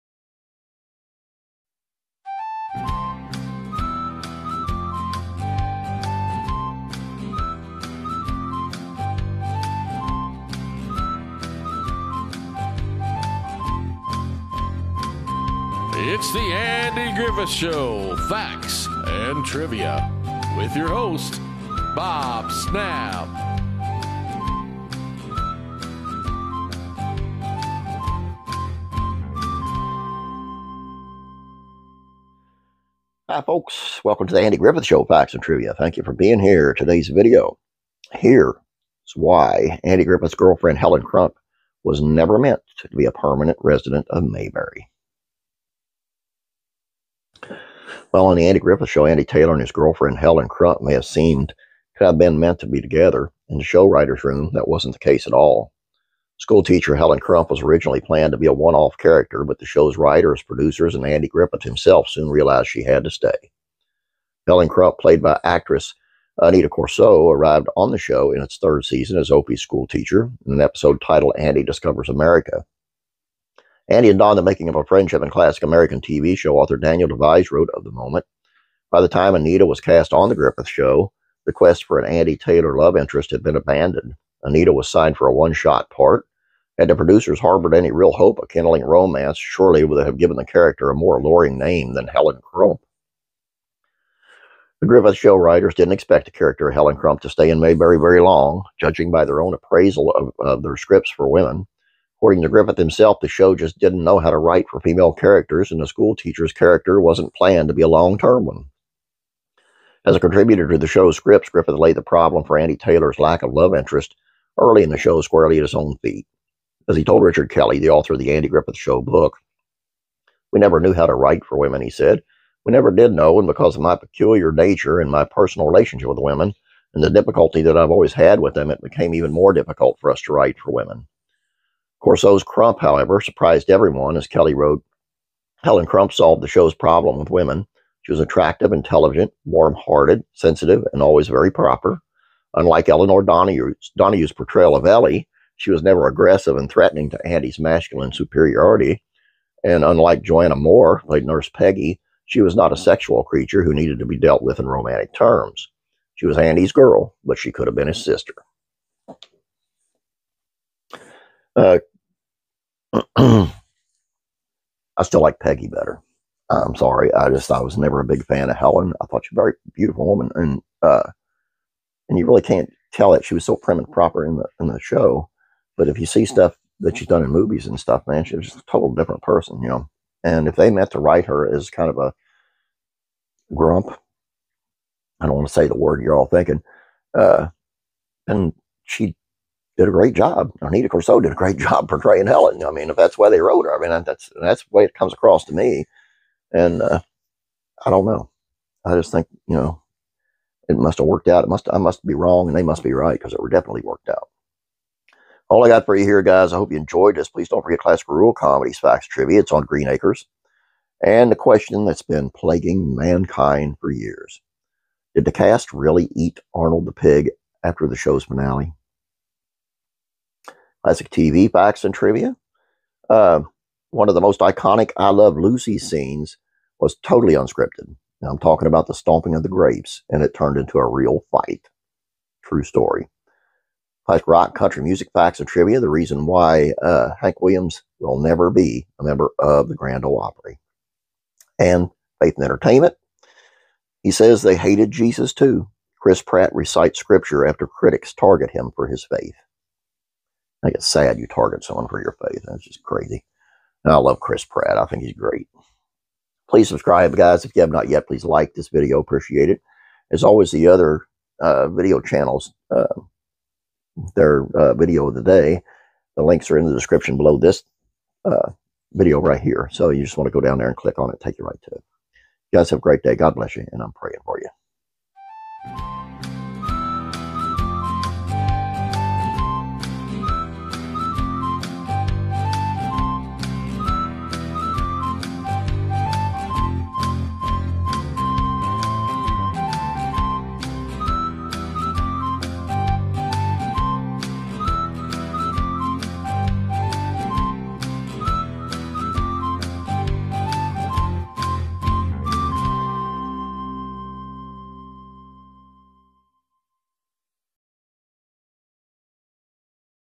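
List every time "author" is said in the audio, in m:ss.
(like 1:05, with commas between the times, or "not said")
1:16, 1:57.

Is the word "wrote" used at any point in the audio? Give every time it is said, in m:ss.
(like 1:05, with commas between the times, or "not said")
1:17, 2:14, 3:13.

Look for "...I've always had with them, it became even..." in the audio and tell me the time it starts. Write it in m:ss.
2:07.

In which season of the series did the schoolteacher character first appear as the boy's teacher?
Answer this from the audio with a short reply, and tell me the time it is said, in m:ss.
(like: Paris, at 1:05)
third season, at 1:08.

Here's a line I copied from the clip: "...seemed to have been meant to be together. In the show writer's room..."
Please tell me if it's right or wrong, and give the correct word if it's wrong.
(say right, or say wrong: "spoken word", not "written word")
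right.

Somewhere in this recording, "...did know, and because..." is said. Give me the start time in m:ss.
2:02.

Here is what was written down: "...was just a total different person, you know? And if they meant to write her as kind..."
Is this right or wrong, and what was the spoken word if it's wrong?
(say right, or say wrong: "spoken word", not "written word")
right.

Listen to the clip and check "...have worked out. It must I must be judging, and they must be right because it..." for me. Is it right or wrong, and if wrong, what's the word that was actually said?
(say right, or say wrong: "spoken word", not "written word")
wrong: "wrong", not "judging".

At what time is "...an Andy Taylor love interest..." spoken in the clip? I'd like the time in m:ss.
1:21.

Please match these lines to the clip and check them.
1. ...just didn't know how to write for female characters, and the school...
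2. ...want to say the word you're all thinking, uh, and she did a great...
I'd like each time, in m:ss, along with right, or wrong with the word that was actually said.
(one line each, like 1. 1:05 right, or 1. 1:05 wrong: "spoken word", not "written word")
1. 1:43 right
2. 3:05 right.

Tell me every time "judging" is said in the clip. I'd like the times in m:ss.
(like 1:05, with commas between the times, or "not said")
1:38.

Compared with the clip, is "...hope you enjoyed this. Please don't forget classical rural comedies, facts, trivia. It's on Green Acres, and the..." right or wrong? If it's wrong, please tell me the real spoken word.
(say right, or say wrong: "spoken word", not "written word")
right.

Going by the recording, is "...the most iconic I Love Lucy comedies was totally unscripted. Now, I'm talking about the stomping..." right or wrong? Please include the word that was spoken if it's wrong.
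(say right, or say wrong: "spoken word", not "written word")
wrong: "scenes", not "comedies".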